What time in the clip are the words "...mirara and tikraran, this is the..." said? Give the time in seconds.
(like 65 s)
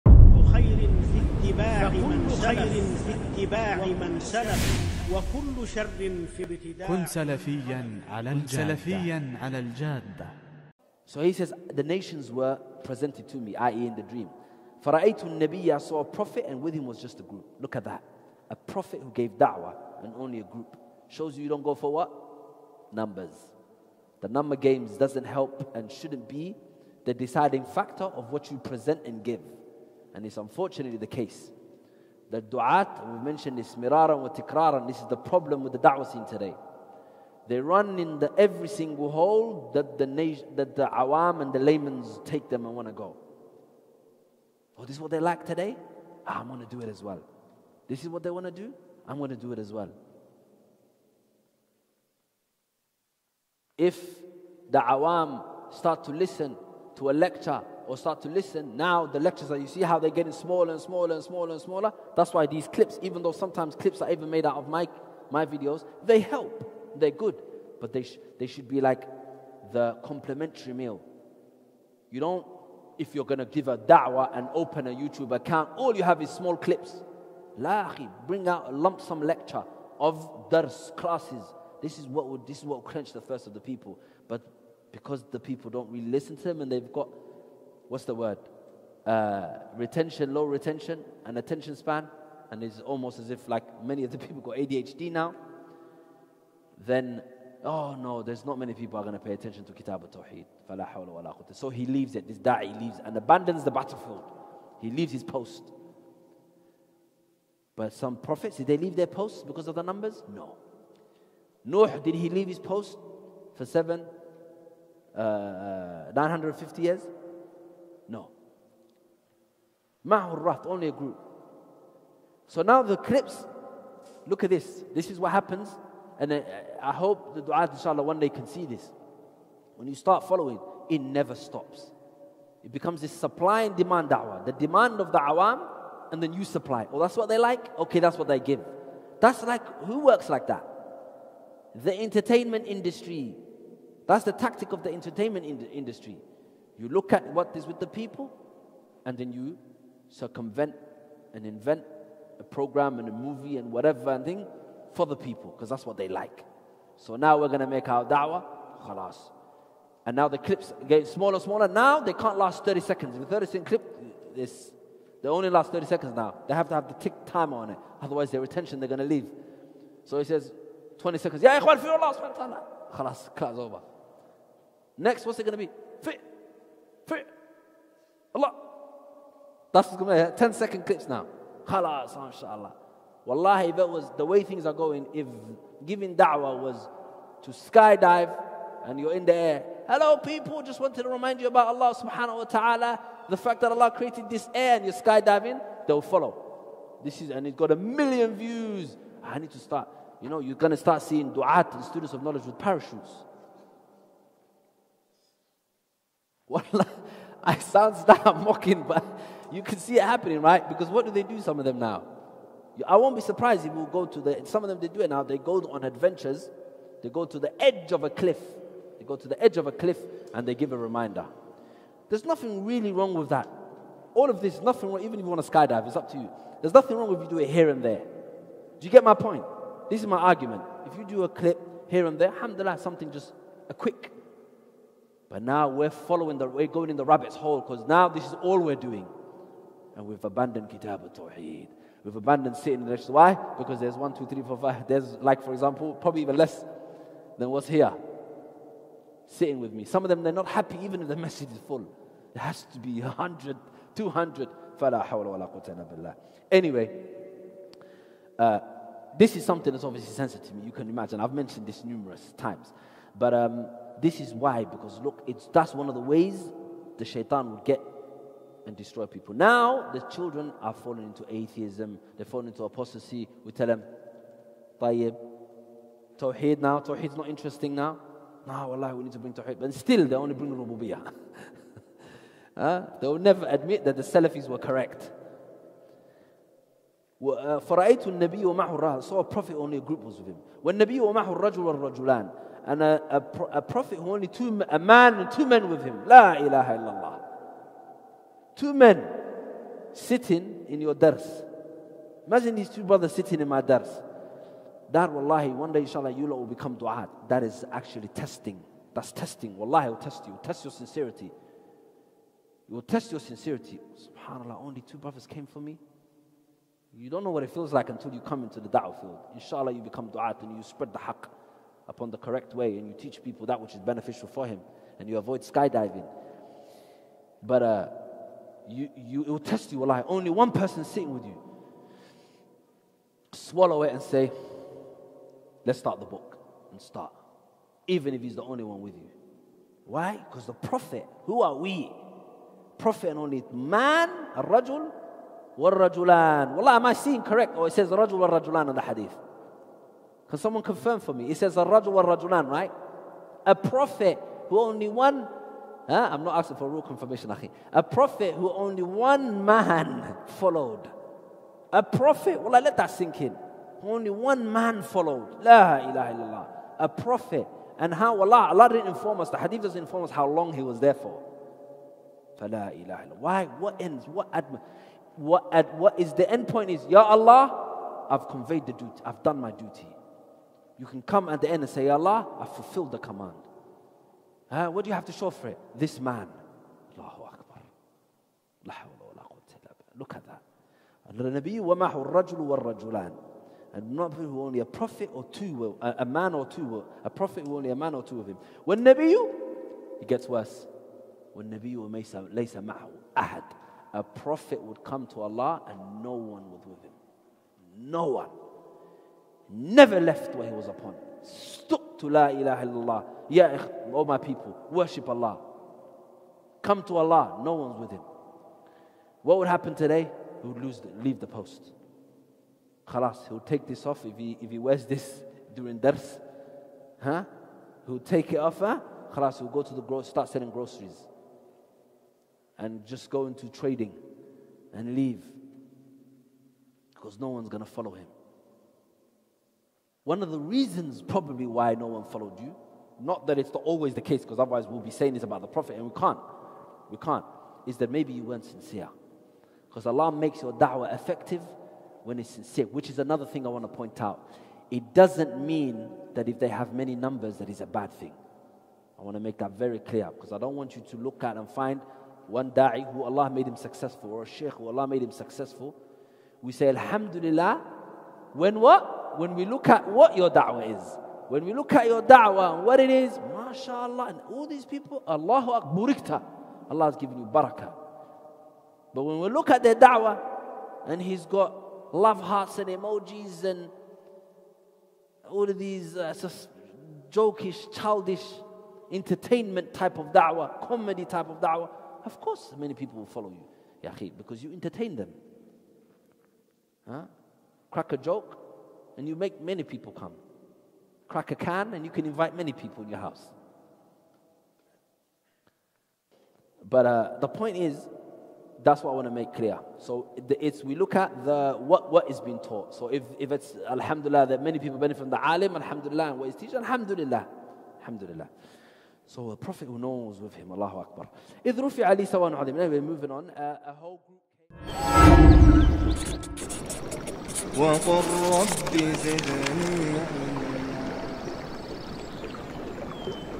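33 s.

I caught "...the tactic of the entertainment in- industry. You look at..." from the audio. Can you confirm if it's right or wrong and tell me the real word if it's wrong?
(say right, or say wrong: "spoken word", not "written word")
right.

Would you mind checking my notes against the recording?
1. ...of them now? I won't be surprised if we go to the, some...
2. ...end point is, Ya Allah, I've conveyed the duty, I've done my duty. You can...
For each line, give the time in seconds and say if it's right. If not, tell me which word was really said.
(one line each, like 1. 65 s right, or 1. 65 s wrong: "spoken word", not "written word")
1. 211 s right
2. 376 s right.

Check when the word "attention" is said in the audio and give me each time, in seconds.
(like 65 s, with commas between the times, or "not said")
91 s, 99 s, 168 s.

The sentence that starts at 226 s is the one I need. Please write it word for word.
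There's nothing wrong if you do it here and there.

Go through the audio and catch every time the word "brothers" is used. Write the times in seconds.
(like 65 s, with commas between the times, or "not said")
302 s, 314 s.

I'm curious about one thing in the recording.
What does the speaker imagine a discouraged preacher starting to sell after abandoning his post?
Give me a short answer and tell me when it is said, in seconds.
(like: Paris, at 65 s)
Groceries, at 430 s.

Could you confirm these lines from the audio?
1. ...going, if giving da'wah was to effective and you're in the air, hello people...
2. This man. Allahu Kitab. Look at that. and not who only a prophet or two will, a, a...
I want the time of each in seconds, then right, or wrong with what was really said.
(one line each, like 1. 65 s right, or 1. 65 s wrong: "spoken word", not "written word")
1. 184 s wrong: "skydive", not "effective"
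2. 385 s wrong: "Akbar", not "Kitab".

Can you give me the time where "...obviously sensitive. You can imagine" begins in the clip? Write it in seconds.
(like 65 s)
259 s.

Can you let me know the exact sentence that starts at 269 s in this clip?
Now, the children are falling into atheism, they're falling into apostasy.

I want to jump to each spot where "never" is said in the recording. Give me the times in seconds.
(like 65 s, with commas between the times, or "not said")
131 s, 283 s, 409 s.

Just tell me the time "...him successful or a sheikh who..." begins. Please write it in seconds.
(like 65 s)
463 s.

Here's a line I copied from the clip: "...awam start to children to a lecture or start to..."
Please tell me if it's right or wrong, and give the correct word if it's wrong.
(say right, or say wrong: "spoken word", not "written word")
wrong: "listen", not "children".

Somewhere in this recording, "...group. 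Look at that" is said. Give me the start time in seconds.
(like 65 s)
17 s.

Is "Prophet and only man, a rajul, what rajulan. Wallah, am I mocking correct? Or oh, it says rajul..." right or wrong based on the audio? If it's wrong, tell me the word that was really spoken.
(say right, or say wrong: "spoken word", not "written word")
wrong: "seeing", not "mocking".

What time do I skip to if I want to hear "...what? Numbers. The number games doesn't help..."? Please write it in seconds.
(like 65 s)
21 s.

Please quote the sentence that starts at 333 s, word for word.
Swallow it and say, let's start the book and start.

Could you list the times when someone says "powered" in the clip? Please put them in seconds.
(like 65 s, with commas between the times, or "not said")
not said.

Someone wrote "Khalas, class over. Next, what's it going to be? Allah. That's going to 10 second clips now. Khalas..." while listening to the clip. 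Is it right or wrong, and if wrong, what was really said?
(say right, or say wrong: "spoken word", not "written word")
right.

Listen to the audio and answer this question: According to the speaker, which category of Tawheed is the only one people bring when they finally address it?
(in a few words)
Rububiyah.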